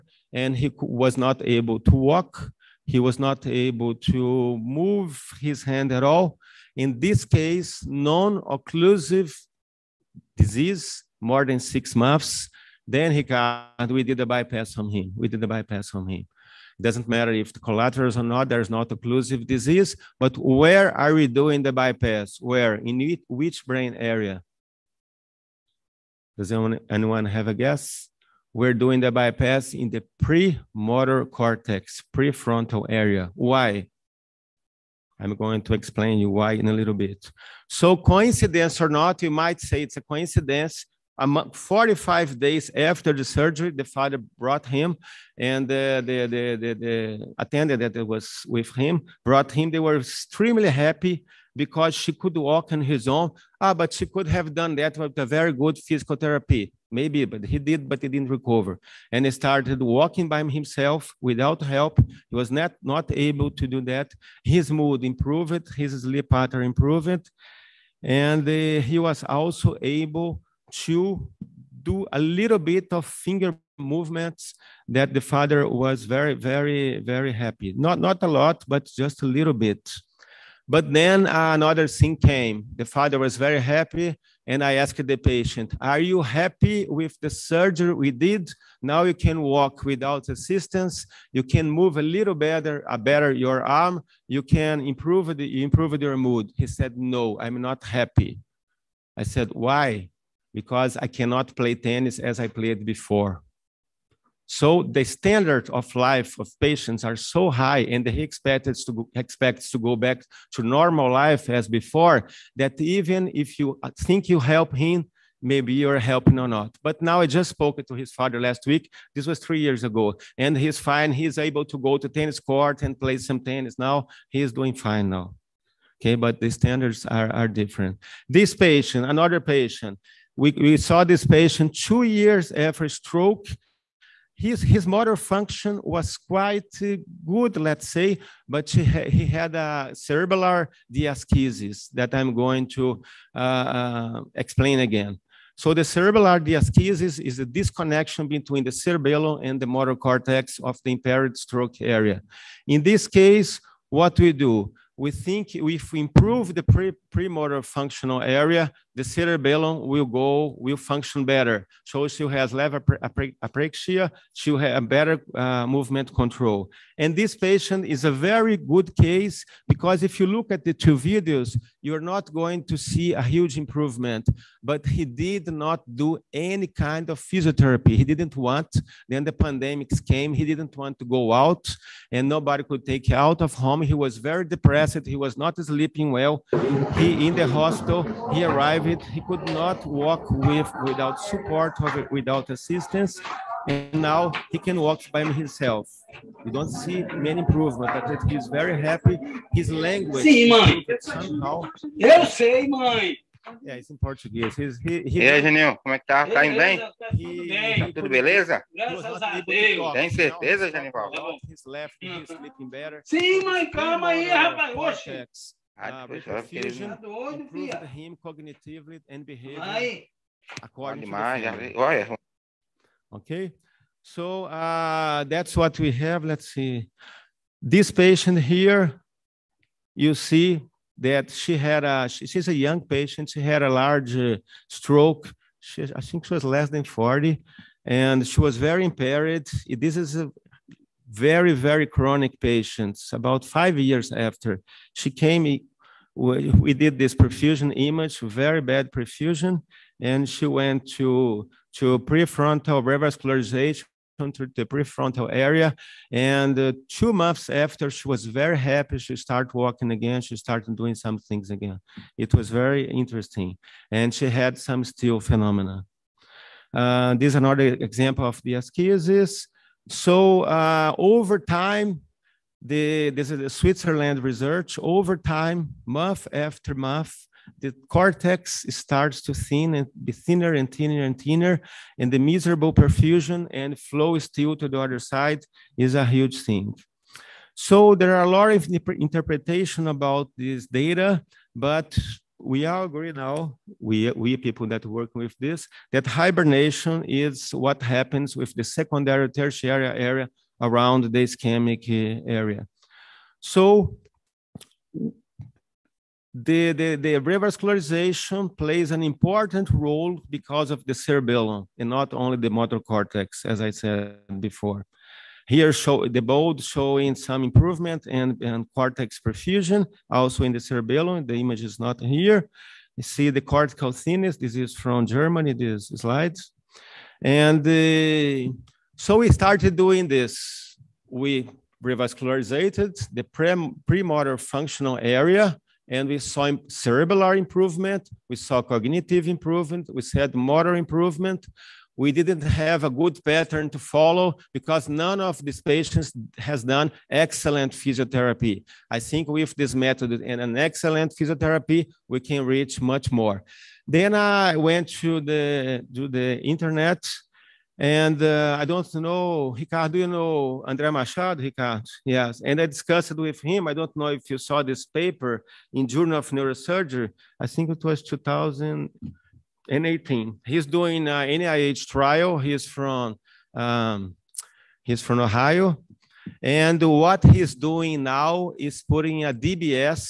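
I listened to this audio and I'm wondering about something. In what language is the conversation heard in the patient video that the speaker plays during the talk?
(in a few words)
Portuguese.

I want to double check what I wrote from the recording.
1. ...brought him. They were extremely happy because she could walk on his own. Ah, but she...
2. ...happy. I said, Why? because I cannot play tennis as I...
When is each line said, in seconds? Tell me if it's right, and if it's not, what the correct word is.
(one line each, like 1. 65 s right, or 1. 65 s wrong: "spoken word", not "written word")
1. 49 s right
2. 97 s right.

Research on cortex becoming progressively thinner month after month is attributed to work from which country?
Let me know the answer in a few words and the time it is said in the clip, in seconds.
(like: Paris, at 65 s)
Switzerland, at 273 s.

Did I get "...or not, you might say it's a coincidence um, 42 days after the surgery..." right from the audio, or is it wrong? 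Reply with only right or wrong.
wrong.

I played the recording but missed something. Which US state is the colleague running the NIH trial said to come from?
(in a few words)
Ohio.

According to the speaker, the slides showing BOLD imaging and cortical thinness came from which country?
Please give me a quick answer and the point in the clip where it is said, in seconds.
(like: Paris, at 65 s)
Germany, at 325 s.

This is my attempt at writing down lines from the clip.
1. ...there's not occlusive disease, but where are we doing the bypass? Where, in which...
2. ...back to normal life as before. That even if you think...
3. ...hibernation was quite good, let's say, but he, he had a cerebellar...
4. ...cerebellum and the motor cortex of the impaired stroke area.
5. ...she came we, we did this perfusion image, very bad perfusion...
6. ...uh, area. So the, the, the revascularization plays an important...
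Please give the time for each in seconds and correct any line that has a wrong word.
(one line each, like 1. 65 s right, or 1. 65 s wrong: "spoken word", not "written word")
1. 18 s right
2. 110 s right
3. 135 s wrong: "function", not "hibernation"
4. 148 s right
5. 244 s right
6. 301 s right.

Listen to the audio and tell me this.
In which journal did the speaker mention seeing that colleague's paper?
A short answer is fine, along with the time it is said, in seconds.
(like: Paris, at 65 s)
Journal of Neurosurgery, at 365 s.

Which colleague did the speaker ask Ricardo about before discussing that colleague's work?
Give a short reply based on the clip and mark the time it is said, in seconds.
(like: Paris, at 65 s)
André Machado, at 360 s.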